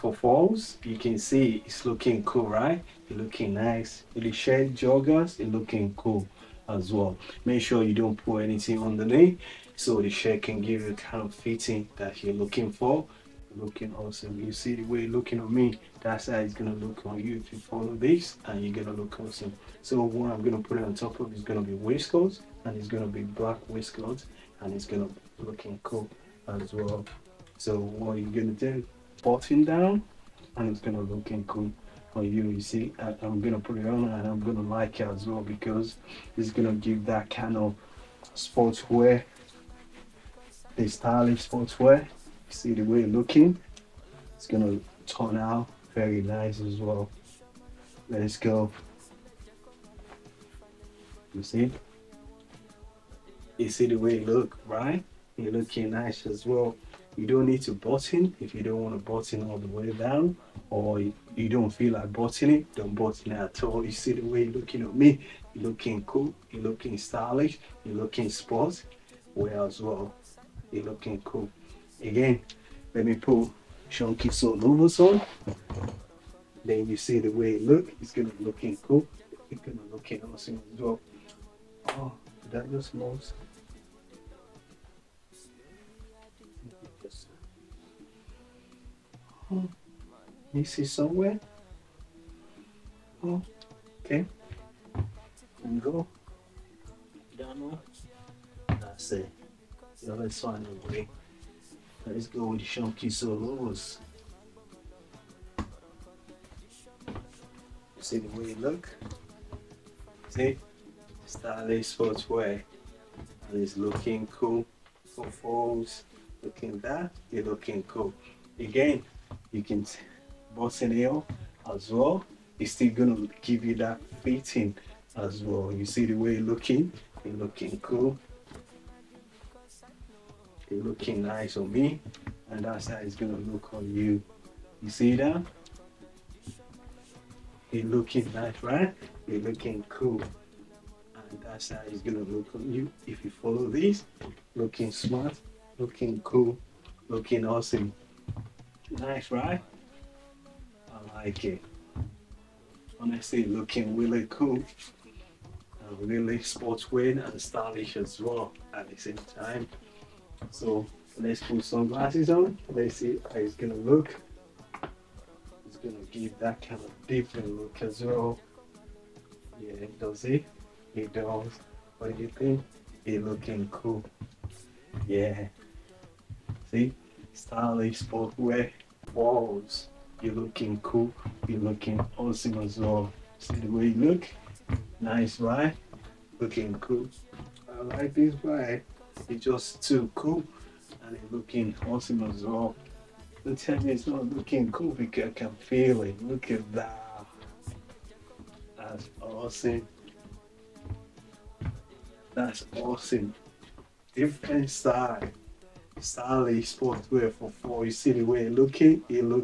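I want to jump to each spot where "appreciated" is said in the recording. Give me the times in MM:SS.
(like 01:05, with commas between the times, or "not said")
not said.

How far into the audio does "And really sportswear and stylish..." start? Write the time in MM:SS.
02:35.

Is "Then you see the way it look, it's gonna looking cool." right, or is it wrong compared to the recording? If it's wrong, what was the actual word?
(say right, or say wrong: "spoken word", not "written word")
right.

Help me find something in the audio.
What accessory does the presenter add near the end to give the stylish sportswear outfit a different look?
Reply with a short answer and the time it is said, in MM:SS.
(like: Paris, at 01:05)
Sunglasses, at 02:41.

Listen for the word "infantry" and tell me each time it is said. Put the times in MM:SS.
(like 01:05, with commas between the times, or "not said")
not said.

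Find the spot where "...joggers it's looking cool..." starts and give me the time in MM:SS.
00:04.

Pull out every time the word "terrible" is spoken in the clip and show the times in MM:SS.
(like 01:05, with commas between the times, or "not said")
not said.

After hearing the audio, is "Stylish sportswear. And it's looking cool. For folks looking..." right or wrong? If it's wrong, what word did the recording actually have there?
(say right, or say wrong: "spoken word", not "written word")
right.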